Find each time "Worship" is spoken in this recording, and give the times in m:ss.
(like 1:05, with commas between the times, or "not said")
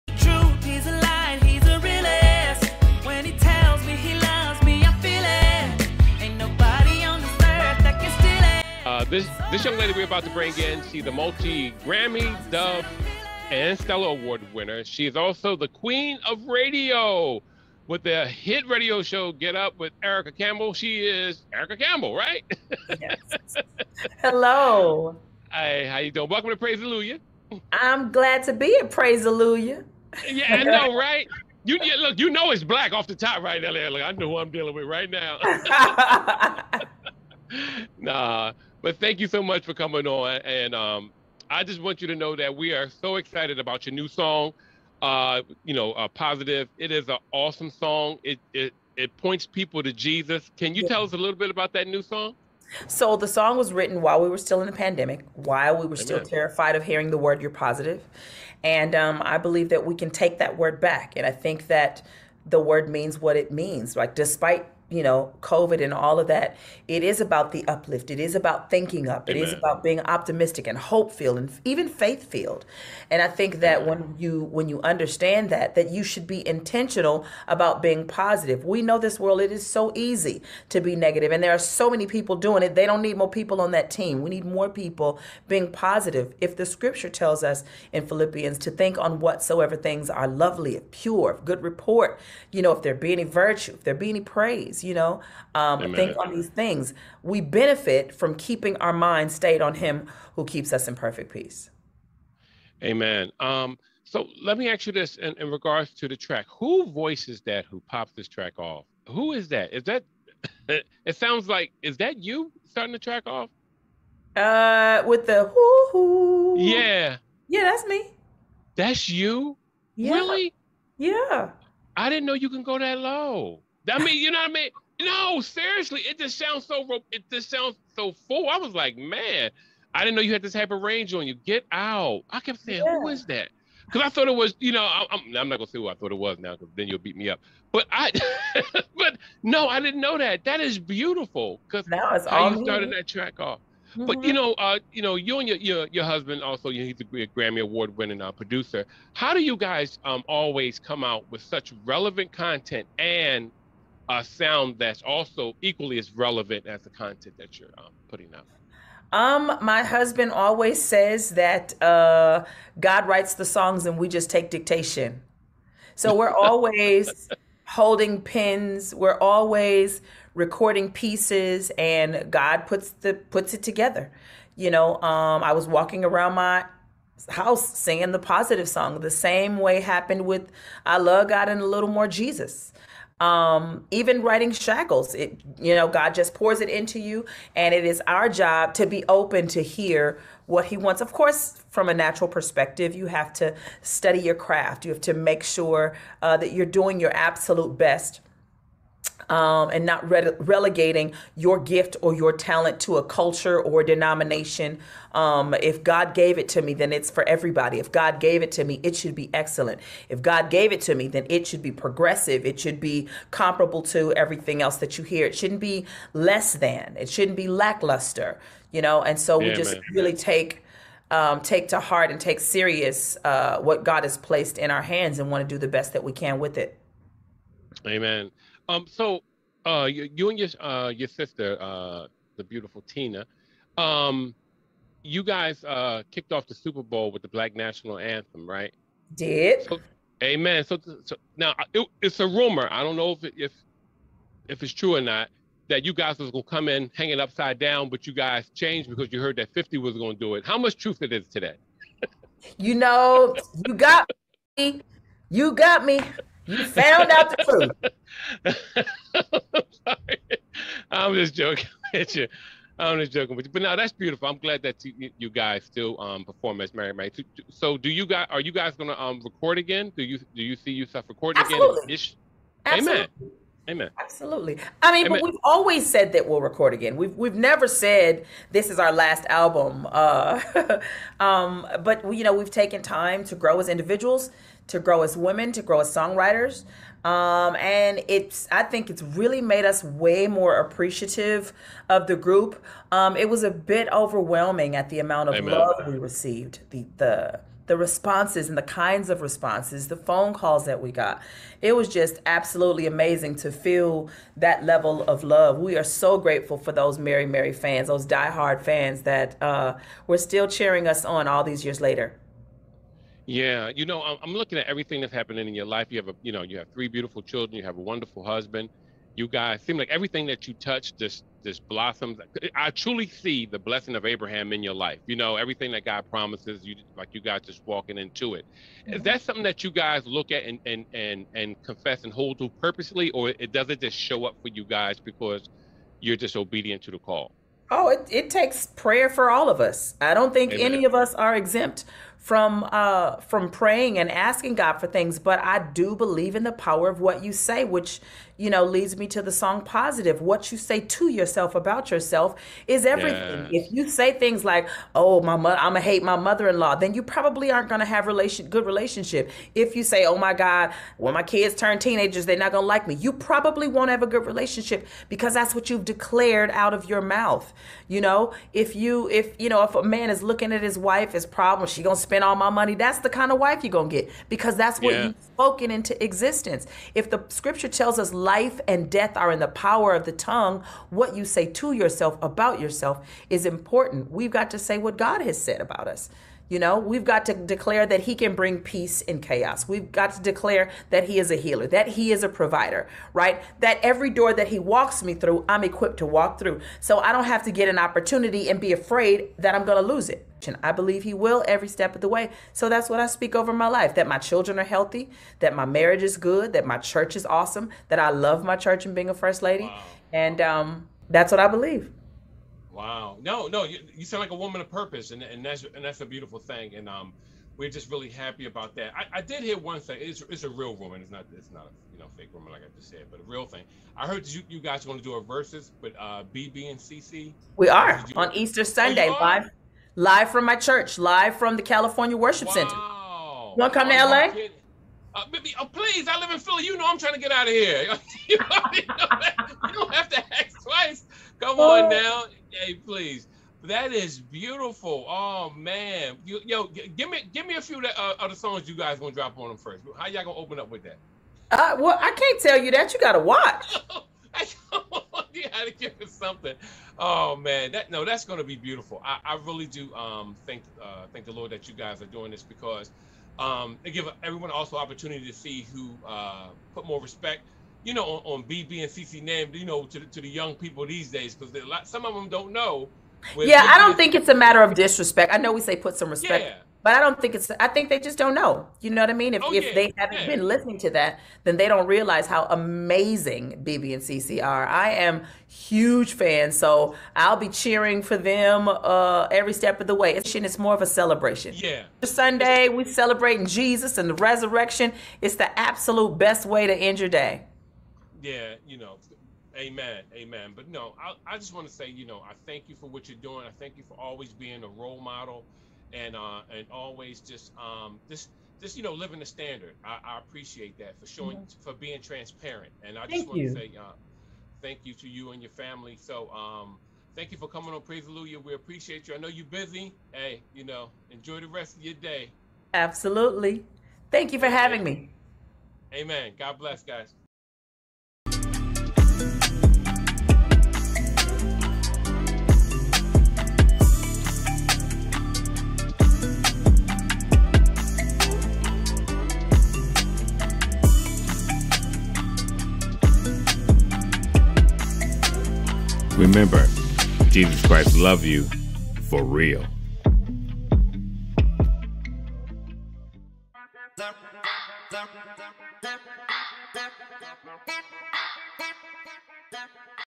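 7:12.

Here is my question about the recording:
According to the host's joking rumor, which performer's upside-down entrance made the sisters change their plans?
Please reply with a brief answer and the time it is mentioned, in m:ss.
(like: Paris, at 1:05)
50, at 4:09.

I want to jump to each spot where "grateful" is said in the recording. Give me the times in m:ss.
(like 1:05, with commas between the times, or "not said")
5:06.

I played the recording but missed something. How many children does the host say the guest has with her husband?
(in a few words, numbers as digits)
3.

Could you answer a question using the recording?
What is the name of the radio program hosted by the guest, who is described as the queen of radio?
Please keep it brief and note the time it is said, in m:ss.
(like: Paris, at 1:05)
Get Up with Erica Campbell, at 0:19.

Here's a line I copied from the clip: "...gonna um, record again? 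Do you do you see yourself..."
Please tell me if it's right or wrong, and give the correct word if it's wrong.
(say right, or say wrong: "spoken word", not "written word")
right.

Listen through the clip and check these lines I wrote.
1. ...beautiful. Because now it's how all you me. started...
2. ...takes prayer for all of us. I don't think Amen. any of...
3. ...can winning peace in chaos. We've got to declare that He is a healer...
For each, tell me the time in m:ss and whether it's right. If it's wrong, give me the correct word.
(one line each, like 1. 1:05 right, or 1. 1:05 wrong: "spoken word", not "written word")
1. 2:20 right
2. 5:38 right
3. 6:28 wrong: "bring", not "winning".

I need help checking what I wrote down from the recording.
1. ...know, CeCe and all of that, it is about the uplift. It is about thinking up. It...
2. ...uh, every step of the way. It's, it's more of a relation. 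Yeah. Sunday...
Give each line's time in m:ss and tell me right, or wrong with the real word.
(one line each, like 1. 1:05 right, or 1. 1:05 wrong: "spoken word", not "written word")
1. 1:05 wrong: "COVID", not "CeCe"
2. 8:08 wrong: "celebration", not "relation".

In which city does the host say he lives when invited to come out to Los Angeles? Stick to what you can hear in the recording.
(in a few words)
Philly.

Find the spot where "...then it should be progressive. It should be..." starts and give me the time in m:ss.
3:31.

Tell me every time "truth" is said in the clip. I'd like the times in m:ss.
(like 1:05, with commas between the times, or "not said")
4:10, 4:18.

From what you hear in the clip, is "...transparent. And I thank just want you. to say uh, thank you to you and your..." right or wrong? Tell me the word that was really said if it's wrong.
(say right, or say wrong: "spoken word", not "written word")
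right.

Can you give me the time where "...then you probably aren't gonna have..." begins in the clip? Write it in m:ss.
5:56.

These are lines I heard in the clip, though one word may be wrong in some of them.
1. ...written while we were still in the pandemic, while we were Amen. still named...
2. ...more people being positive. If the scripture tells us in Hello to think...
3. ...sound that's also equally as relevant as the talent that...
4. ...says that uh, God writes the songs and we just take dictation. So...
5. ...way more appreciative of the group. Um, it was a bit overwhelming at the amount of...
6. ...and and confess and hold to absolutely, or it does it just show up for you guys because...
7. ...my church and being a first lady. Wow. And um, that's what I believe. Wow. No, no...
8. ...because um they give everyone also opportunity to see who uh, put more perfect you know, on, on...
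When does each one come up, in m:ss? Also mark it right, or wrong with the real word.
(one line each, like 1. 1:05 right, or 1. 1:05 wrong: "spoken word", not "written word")
1. 0:53 wrong: "terrified", not "named"
2. 1:24 wrong: "Philippians", not "Hello"
3. 2:34 wrong: "content", not "talent"
4. 2:40 right
5. 4:49 right
6. 5:30 wrong: "purposely", not "absolutely"
7. 6:48 right
8. 7:42 wrong: "respect", not "perfect".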